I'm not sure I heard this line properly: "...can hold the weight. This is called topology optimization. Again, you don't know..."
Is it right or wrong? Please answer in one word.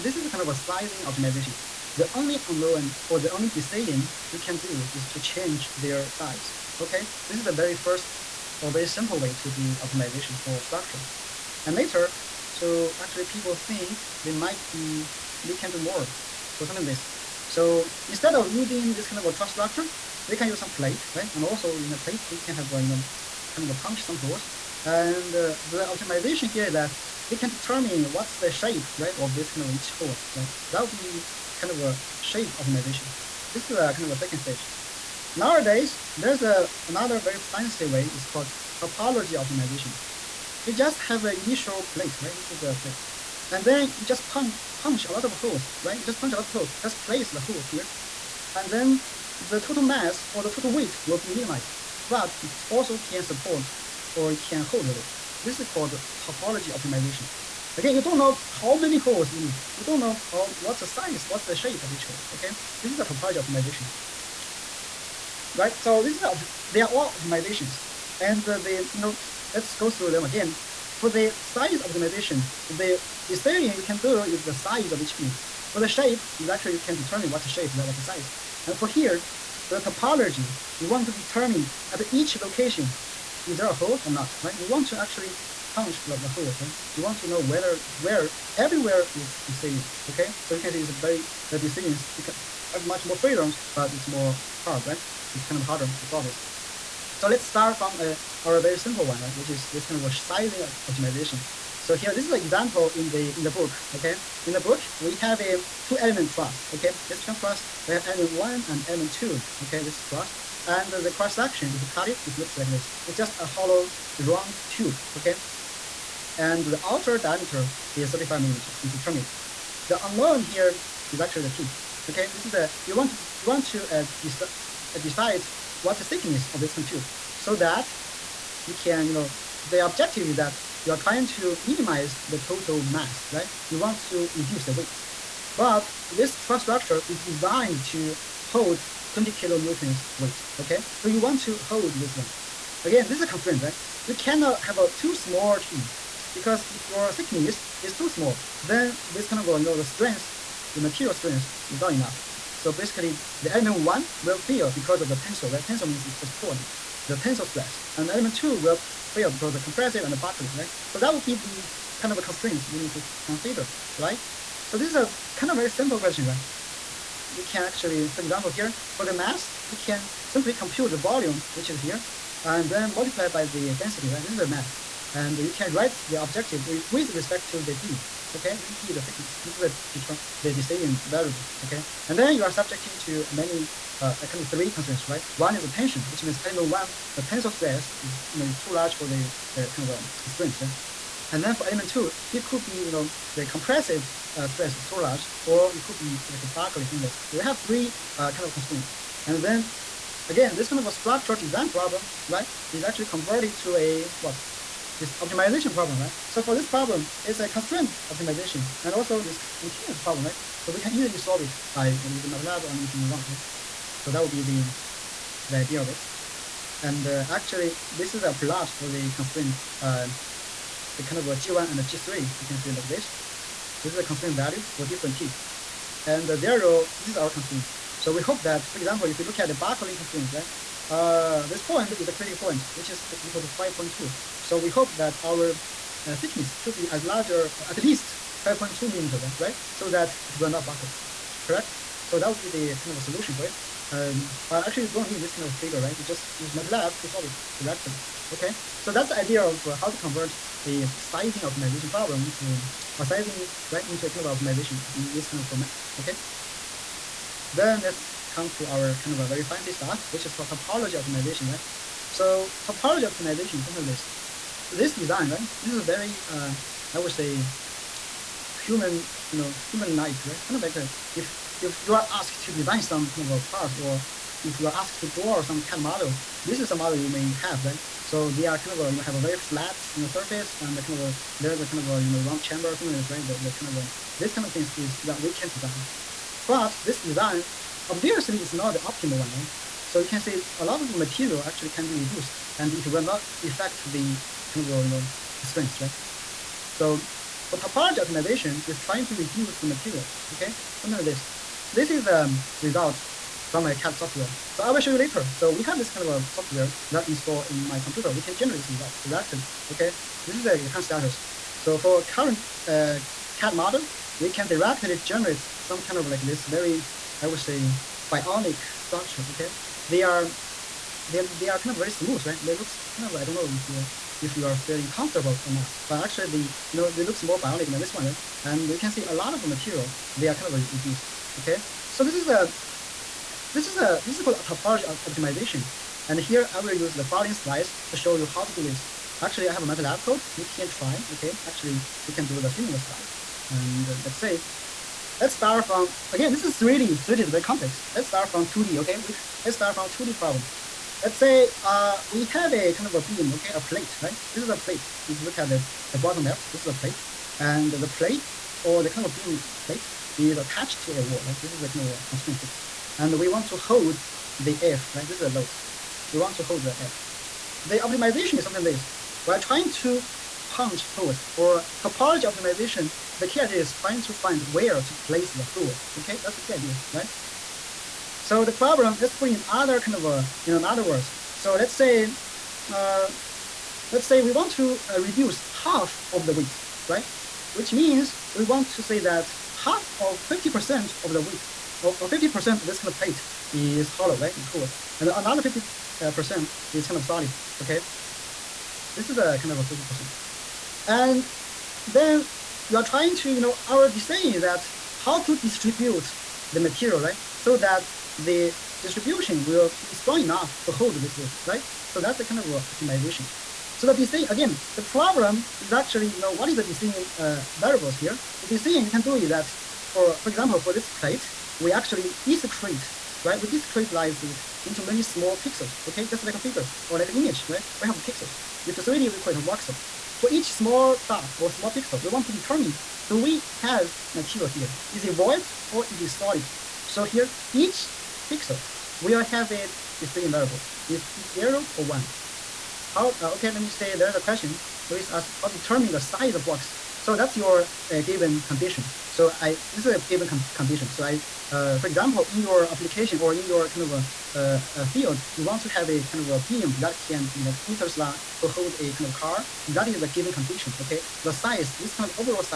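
right.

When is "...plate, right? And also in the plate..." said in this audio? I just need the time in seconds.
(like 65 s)
20 s.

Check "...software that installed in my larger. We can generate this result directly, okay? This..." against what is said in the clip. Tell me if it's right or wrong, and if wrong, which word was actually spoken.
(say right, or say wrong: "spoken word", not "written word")
wrong: "computer", not "larger".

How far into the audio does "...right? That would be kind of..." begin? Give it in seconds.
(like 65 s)
30 s.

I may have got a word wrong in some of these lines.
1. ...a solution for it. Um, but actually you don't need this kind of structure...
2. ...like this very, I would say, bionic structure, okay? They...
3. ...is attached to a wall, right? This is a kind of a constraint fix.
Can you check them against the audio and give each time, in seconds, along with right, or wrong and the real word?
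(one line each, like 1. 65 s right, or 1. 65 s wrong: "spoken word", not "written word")
1. 242 s wrong: "figure", not "structure"
2. 316 s right
3. 360 s right.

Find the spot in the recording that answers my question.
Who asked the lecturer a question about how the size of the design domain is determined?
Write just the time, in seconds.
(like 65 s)
444 s.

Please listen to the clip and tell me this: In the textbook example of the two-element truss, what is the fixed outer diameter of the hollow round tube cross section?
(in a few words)
35 millimeters.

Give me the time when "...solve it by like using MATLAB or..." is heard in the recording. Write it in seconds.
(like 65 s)
211 s.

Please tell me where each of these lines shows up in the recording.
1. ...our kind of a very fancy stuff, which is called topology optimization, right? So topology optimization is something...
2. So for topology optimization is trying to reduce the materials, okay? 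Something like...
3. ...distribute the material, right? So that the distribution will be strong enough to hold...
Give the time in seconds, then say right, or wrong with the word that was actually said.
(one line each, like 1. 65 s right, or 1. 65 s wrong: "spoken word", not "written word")
1. 258 s right
2. 296 s right
3. 405 s right.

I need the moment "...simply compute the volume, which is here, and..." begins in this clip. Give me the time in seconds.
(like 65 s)
170 s.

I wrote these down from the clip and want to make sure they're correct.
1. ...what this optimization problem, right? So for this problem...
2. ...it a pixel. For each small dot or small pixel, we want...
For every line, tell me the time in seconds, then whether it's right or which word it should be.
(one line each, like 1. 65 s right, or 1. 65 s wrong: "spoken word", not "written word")
1. 204 s right
2. 429 s wrong: "voxel", not "pixel".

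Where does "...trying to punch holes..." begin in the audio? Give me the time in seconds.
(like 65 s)
369 s.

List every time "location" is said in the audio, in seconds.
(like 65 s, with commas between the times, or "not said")
82 s.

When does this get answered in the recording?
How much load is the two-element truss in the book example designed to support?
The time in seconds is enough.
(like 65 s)
139 s.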